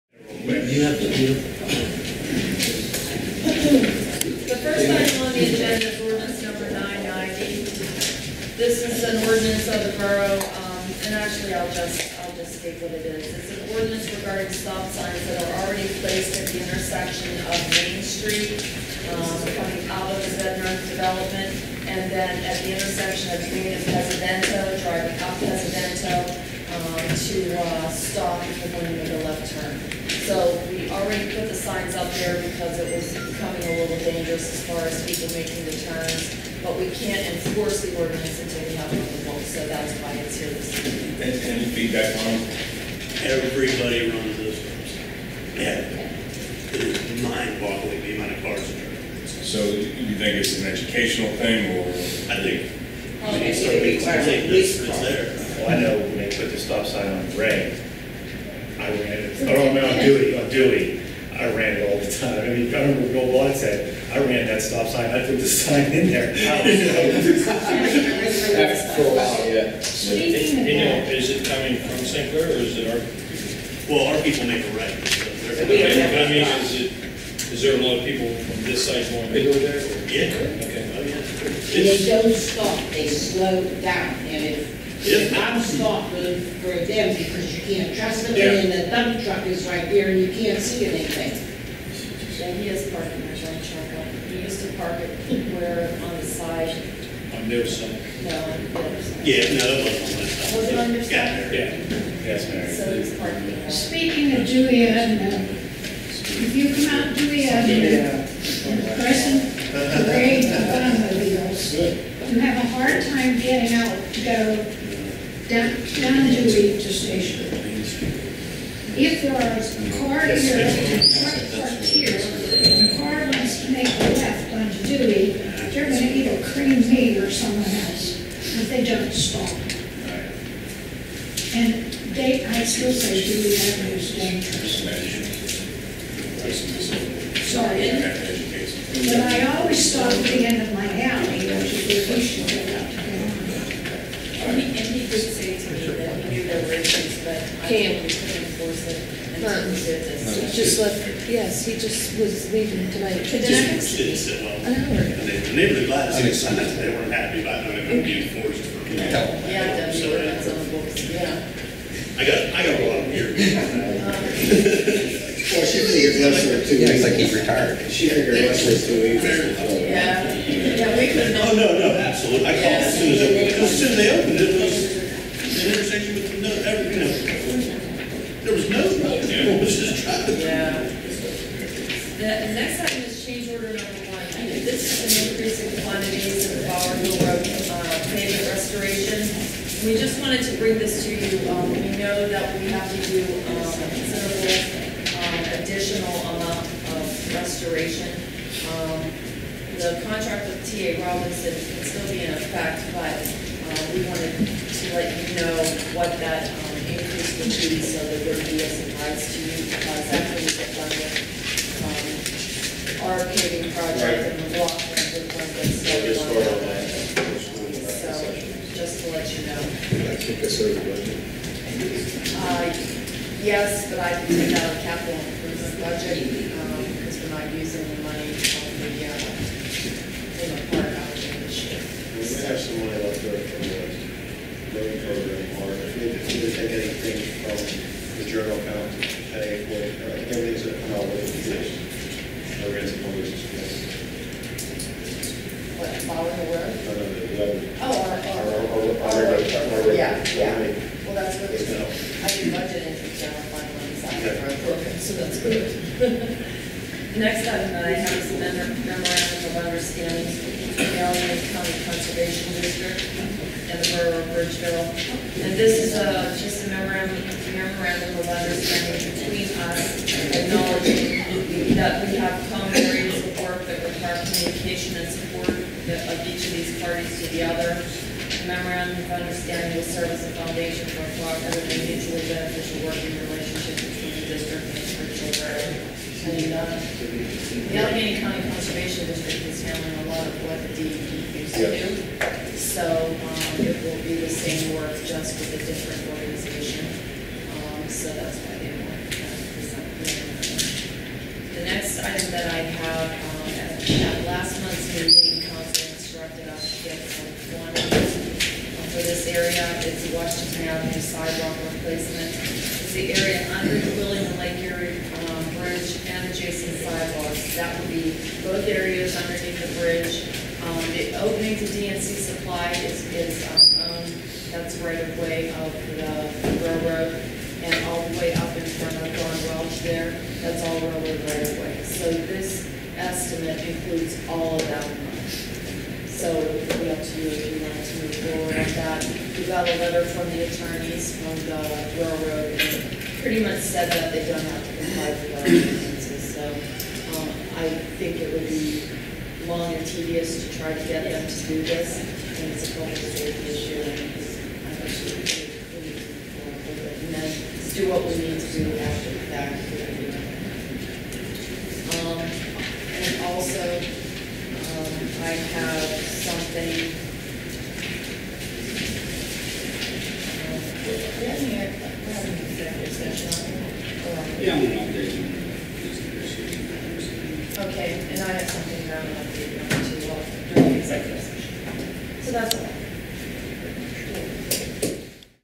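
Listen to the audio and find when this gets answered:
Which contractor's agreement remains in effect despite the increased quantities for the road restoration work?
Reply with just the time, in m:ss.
3:20.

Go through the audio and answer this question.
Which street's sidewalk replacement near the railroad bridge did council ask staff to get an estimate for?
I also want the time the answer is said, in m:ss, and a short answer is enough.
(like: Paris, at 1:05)
Washington Avenue, at 5:10.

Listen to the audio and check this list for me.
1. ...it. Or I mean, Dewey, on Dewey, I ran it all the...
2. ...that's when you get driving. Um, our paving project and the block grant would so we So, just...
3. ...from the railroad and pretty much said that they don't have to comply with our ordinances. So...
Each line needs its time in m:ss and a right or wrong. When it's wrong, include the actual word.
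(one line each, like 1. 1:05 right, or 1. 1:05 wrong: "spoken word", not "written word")
1. 0:59 right
2. 3:30 wrong: "funding", not "driving"
3. 5:41 right.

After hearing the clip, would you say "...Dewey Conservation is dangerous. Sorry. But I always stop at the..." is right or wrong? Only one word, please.
wrong.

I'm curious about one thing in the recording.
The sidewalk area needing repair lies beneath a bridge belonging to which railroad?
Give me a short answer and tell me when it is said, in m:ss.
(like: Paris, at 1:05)
Wheeling Lake Erie, at 5:14.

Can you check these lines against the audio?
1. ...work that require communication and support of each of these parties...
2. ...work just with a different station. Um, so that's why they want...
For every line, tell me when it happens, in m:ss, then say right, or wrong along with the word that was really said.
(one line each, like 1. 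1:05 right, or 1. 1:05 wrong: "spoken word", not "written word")
1. 4:33 right
2. 4:54 wrong: "organization", not "station".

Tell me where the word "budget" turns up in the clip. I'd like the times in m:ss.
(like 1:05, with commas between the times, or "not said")
3:45, 4:12.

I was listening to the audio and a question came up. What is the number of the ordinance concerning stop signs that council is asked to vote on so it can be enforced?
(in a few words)
990.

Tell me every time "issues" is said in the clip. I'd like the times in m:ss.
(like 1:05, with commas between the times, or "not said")
2:26, 5:53.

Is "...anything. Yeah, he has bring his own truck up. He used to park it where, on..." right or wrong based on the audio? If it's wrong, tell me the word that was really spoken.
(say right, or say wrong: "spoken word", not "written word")
wrong: "parking", not "bring".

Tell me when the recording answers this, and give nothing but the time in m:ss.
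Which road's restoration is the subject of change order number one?
3:06.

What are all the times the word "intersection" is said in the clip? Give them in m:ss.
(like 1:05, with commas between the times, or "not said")
0:16, 0:22, 2:55.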